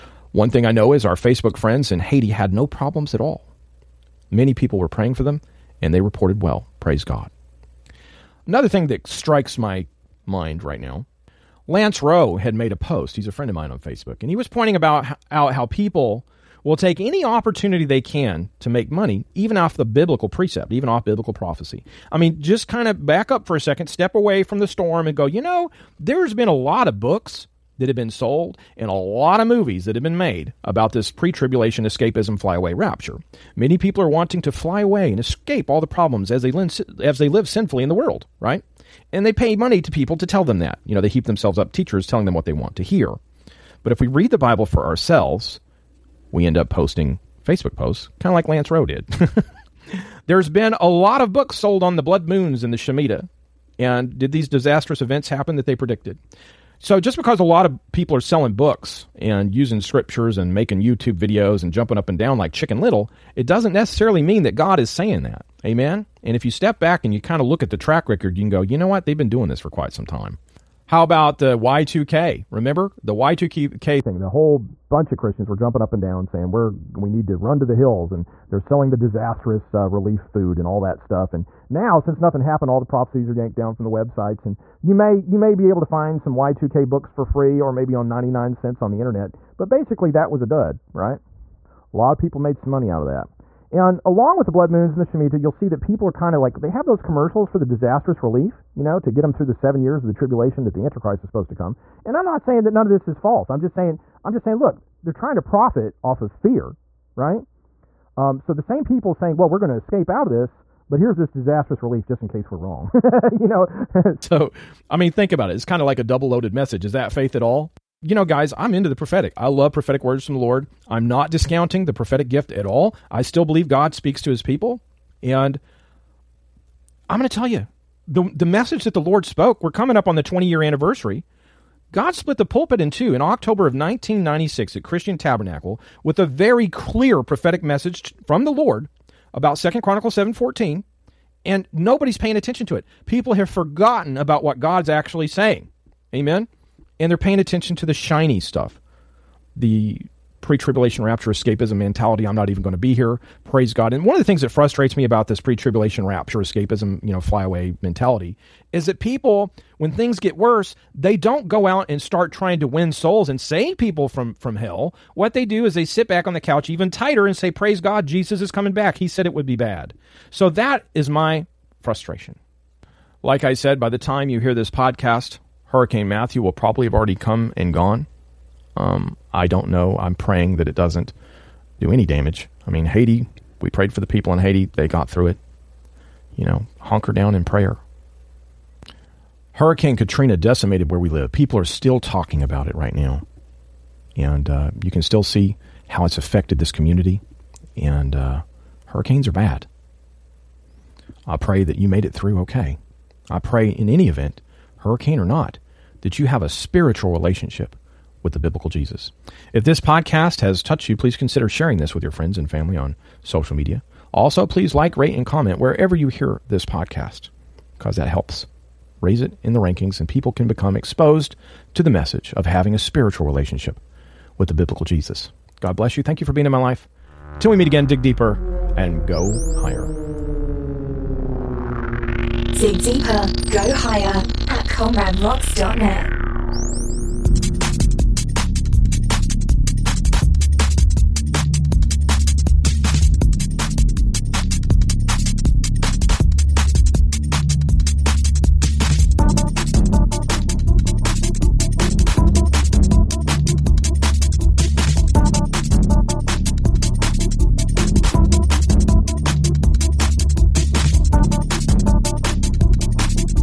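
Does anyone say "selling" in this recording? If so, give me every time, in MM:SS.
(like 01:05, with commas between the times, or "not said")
00:58, 01:18.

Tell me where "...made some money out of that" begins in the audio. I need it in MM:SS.
01:32.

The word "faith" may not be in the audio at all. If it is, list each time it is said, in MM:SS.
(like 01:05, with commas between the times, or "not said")
01:57.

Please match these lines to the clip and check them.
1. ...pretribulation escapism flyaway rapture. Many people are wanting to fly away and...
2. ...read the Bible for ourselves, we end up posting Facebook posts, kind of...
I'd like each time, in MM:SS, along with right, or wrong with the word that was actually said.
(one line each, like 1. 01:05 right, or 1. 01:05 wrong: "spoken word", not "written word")
1. 00:31 wrong: "tribulation", not "pretribulation"
2. 00:44 right.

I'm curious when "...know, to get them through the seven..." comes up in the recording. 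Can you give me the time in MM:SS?
01:38.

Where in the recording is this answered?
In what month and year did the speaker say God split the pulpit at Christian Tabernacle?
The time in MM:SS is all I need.
02:13.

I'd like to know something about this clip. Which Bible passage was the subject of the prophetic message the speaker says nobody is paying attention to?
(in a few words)
Second Chronicles 7:14.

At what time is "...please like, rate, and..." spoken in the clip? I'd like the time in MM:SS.
03:34.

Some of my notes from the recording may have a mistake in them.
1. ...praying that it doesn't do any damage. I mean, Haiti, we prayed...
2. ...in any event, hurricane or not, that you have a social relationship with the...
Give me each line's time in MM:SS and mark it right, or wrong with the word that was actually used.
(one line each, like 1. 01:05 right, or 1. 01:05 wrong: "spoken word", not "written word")
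1. 03:00 right
2. 03:23 wrong: "spiritual", not "social".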